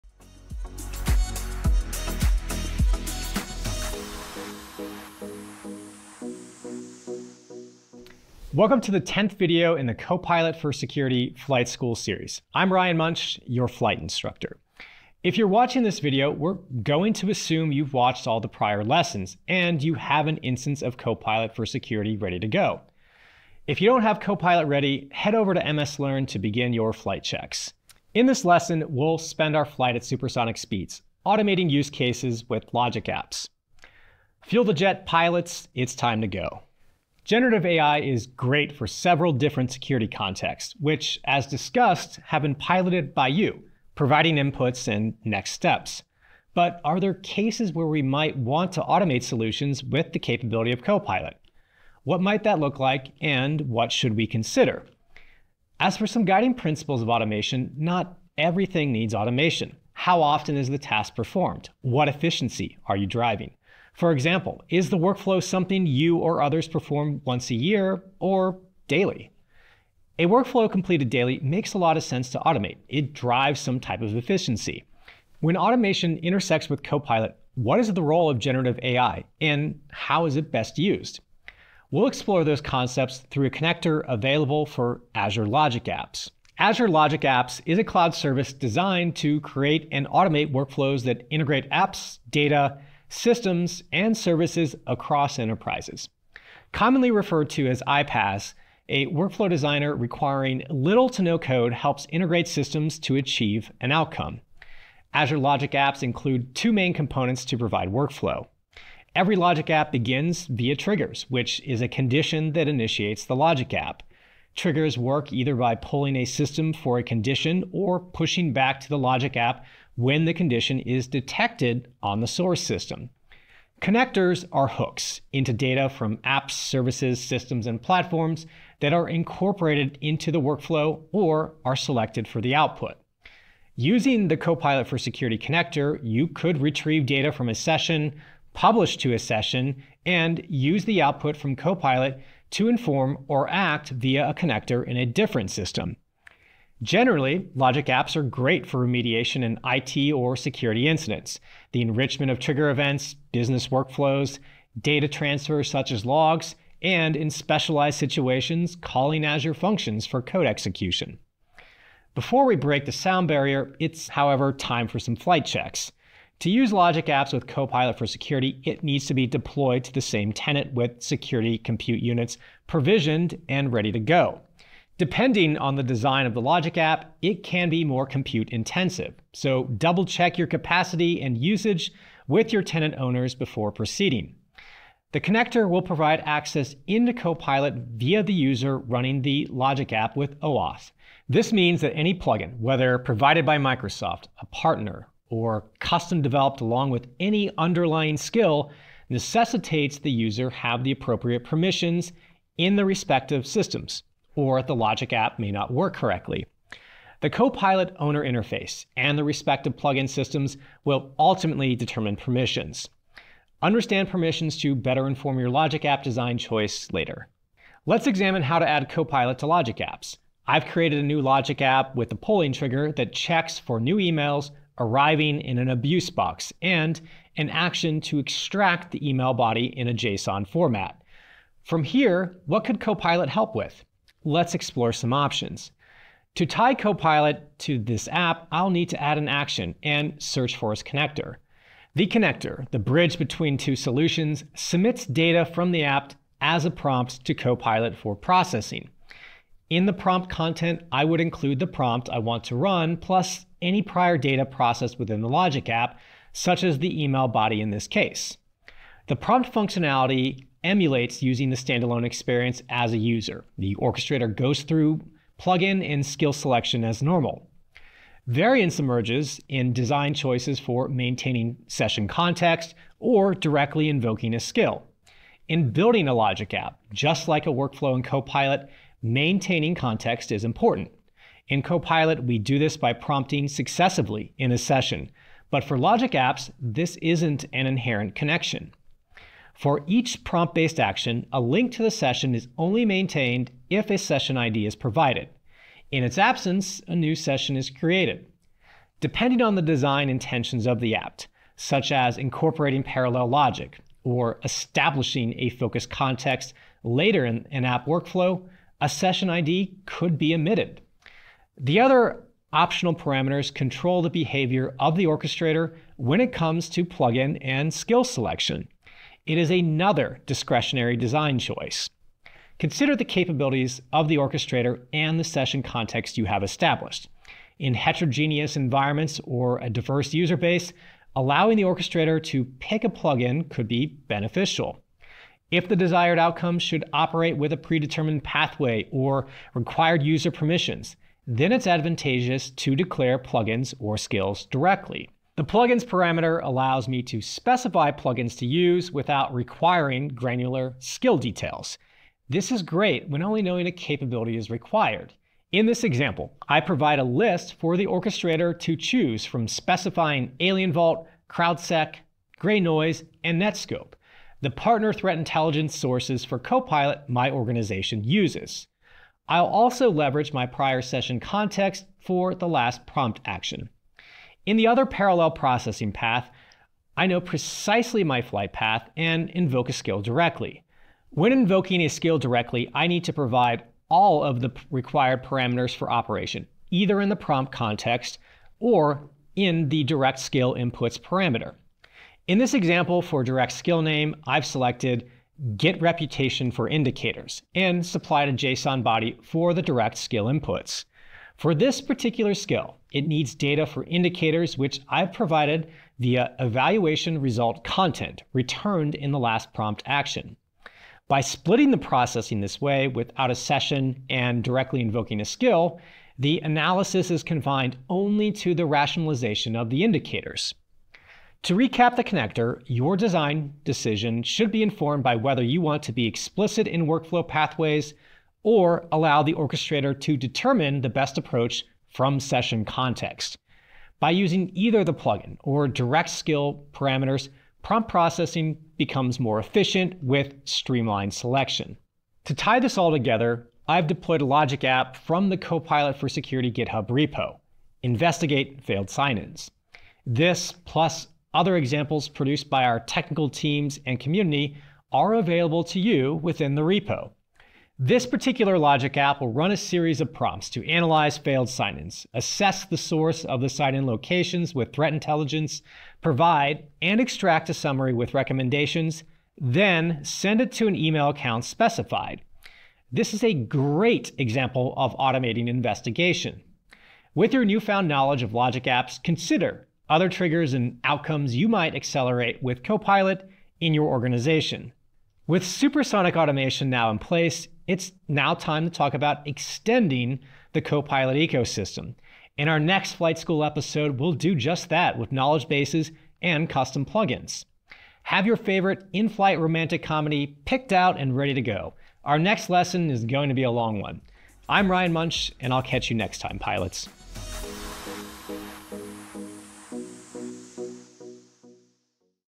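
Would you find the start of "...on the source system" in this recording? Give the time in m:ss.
2:02.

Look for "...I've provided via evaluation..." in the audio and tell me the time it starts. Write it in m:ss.
6:44.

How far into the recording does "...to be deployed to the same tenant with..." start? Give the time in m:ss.
2:49.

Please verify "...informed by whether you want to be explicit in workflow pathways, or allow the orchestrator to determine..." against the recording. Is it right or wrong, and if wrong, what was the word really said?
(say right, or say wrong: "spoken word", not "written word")
right.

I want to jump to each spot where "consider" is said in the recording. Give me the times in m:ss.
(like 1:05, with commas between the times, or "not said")
0:54, 5:22, 7:59.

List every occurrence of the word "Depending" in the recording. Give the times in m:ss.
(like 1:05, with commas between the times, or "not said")
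2:54, 4:59.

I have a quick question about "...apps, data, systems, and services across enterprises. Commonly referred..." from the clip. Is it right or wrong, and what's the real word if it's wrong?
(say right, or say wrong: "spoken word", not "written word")
right.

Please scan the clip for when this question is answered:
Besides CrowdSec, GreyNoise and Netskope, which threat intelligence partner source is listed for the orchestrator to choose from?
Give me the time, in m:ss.
6:00.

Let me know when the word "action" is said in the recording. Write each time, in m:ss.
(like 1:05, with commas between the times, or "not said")
3:47, 3:59, 4:50, 6:13, 6:49.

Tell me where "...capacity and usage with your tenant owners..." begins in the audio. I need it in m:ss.
3:00.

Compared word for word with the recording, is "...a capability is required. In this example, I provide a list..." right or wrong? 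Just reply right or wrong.
right.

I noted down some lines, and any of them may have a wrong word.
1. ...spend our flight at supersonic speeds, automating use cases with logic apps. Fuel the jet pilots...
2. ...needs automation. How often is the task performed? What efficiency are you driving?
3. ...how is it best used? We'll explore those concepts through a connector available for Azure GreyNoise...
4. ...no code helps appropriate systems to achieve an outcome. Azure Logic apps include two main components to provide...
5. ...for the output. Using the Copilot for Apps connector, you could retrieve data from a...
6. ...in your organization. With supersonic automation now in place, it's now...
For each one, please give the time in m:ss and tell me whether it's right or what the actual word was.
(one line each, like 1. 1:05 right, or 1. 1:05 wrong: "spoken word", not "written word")
1. 0:29 right
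2. 0:58 right
3. 1:19 wrong: "Logic", not "GreyNoise"
4. 1:41 wrong: "integrate", not "appropriate"
5. 2:12 wrong: "Security", not "Apps"
6. 8:03 right.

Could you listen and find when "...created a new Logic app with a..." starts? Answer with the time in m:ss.
3:40.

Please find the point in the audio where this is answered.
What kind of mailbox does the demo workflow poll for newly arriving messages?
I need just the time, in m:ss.
3:45.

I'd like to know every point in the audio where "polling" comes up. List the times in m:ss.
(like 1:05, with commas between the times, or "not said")
1:55, 3:42.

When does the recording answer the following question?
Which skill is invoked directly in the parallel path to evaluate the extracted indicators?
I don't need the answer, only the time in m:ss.
6:35.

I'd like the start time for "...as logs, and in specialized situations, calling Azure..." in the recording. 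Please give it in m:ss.
2:35.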